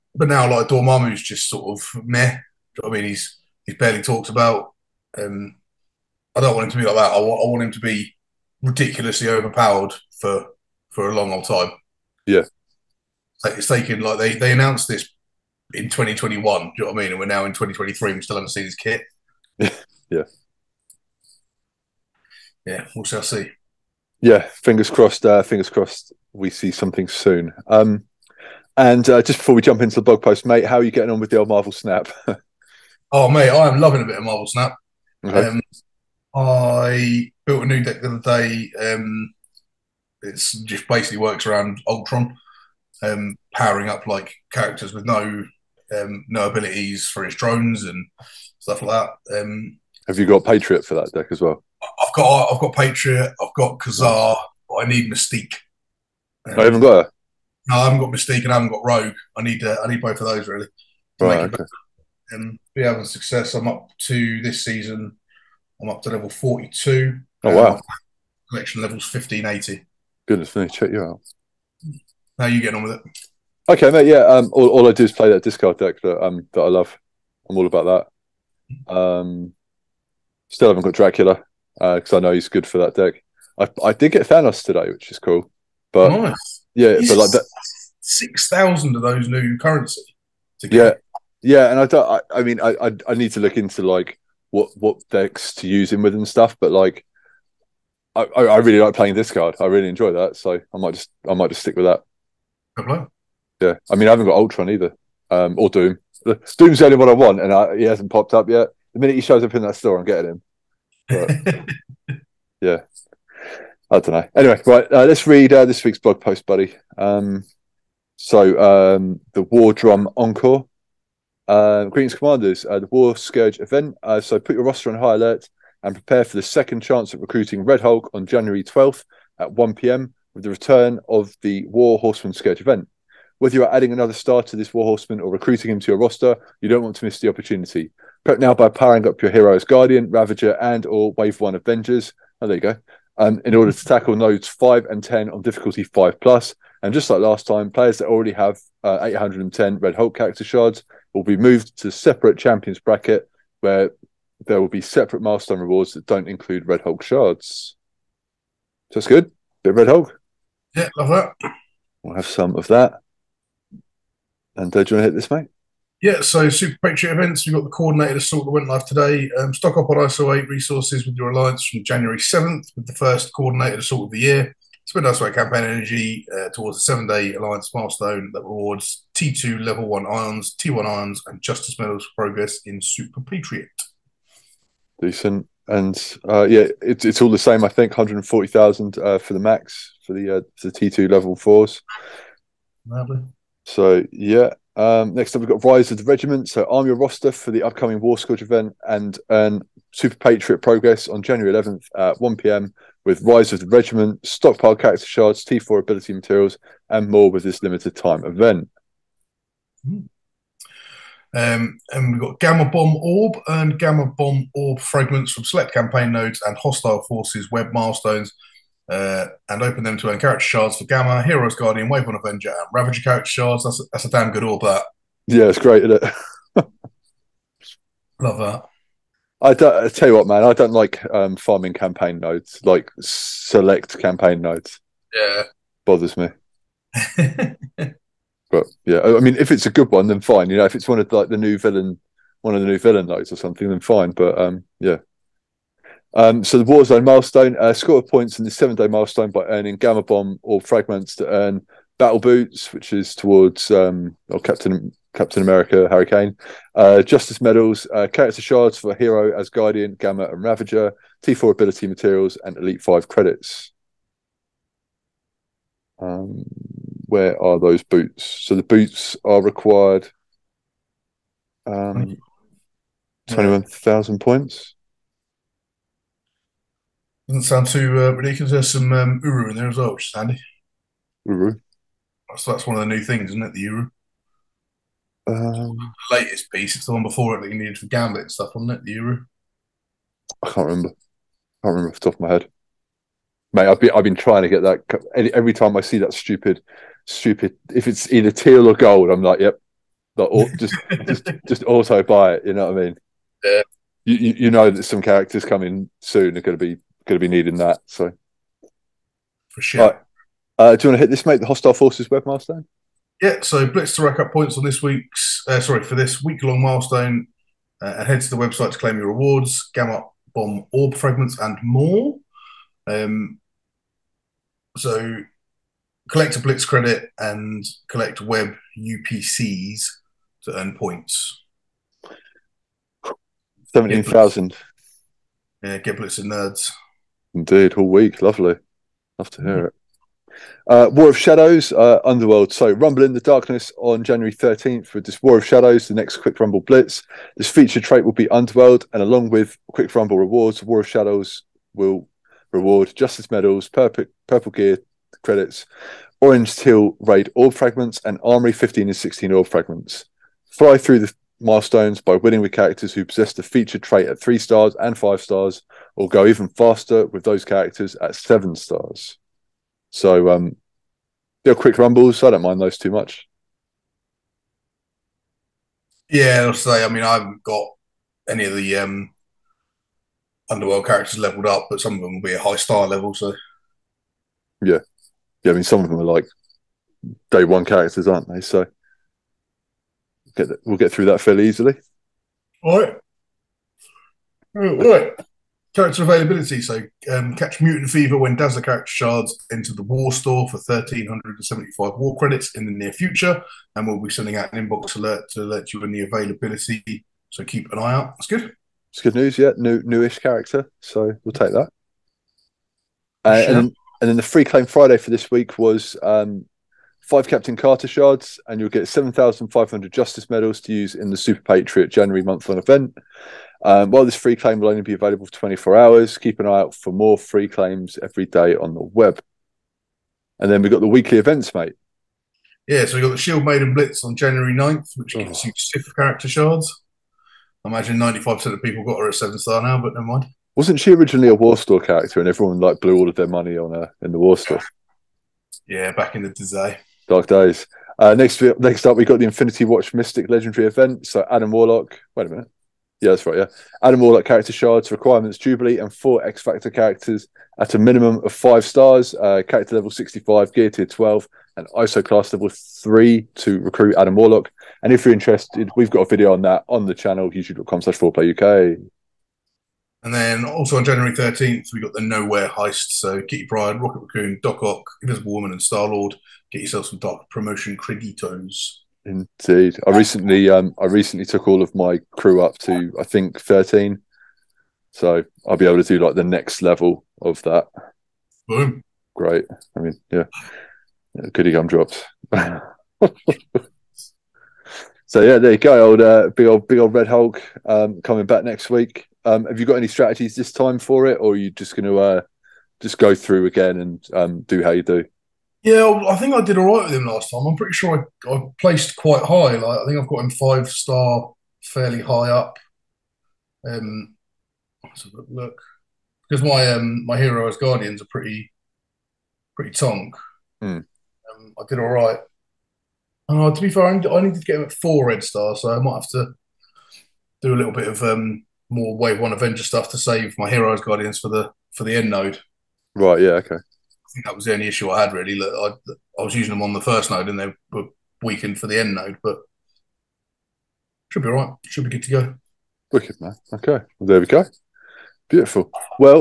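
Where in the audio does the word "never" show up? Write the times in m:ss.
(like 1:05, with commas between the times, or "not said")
7:19.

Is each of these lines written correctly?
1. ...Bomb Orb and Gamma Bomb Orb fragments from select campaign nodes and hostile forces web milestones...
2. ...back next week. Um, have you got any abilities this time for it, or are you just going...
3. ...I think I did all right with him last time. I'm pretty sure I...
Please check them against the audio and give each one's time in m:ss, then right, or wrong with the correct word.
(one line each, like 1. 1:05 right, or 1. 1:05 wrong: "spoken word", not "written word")
1. 3:32 right
2. 8:18 wrong: "strategies", not "abilities"
3. 8:26 right.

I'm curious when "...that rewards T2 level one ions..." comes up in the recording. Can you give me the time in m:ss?
2:58.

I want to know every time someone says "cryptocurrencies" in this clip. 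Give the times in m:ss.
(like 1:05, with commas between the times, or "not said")
not said.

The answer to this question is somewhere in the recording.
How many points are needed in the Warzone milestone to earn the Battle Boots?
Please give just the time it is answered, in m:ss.
4:33.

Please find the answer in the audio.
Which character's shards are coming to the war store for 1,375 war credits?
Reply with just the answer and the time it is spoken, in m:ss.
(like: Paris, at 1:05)
Dazzler, at 6:38.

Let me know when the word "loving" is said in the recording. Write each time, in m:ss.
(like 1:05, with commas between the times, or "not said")
0:33.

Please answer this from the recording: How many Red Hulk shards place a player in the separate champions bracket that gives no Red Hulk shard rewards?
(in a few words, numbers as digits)
810.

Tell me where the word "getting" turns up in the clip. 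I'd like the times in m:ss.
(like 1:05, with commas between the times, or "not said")
0:30, 1:12, 1:50.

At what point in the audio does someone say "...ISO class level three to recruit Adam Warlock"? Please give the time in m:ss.
7:41.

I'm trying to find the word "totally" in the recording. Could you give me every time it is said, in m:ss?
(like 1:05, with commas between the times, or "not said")
not said.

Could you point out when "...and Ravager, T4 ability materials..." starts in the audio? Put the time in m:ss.
4:20.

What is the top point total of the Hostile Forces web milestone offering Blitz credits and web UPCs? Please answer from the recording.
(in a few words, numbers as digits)
17,000.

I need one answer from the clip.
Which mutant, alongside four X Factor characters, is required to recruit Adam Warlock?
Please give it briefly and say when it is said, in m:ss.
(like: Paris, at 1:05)
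Jubilee, at 7:35.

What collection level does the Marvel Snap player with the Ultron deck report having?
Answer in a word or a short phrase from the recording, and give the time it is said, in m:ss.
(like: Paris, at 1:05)
1580, at 1:09.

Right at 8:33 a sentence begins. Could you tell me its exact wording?
Um, let's have a look because my um my hero as guardians are pretty pretty tonk.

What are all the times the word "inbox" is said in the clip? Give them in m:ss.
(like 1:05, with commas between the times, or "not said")
6:44.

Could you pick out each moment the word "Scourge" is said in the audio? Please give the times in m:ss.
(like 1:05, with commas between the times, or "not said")
2:03, 2:12, 3:18.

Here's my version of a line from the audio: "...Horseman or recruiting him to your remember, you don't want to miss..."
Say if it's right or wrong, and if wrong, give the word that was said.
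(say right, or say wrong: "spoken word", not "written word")
wrong: "roster", not "remember".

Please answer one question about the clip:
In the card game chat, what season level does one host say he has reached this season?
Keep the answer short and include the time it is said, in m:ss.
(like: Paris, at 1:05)
42, at 1:06.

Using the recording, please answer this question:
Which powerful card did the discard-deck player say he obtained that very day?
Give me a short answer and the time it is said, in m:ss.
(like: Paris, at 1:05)
Thanos, at 1:24.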